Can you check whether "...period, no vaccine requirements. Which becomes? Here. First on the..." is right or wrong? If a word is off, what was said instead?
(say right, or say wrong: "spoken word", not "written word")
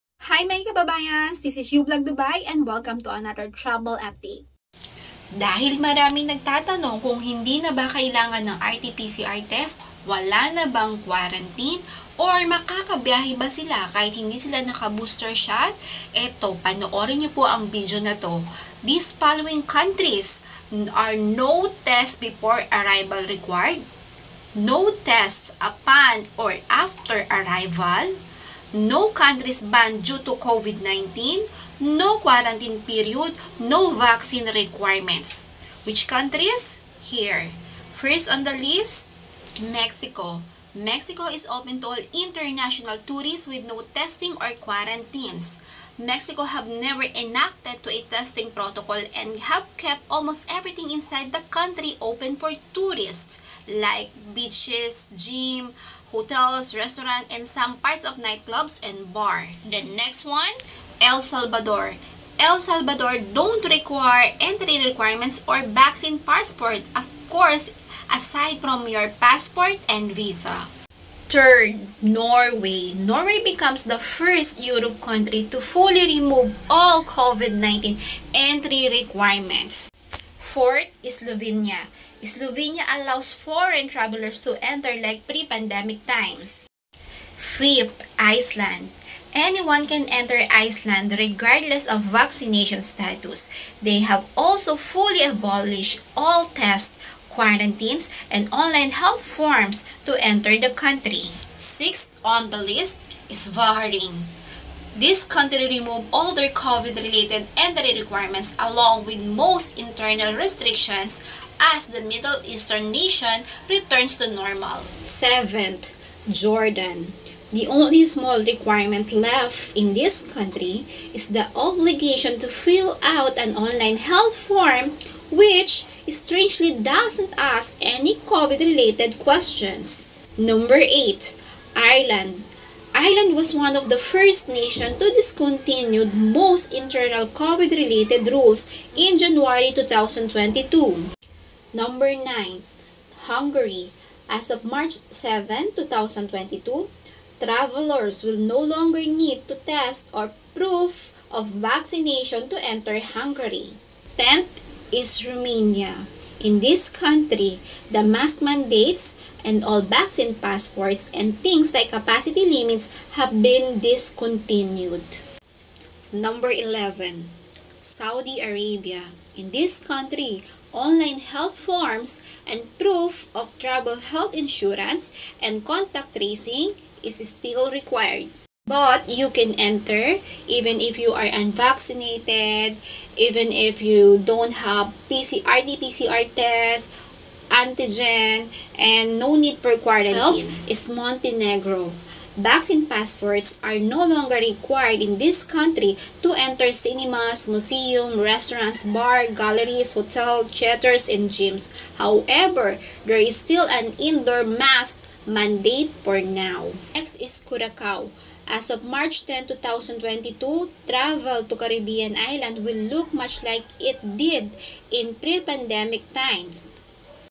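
wrong: "countries", not "becomes".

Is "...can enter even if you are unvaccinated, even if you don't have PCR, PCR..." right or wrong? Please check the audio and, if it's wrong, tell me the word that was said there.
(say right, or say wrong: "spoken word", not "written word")
right.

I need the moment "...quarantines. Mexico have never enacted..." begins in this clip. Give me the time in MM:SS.
00:44.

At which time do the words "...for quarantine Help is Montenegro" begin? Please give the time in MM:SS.
03:09.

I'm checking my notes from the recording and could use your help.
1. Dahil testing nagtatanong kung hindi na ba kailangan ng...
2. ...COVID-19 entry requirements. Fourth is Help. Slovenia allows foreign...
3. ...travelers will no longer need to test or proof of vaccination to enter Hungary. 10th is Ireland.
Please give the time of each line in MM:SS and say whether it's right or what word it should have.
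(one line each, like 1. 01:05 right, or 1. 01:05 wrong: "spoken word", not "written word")
1. 00:05 wrong: "maraming", not "testing"
2. 01:17 wrong: "Slovenia", not "Help"
3. 02:27 wrong: "Romania", not "Ireland".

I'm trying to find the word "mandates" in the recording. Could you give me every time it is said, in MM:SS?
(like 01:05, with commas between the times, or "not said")
02:38, 03:25.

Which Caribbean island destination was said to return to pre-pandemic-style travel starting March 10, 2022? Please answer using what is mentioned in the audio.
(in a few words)
Curacao.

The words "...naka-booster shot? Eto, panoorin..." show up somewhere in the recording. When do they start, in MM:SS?
00:14.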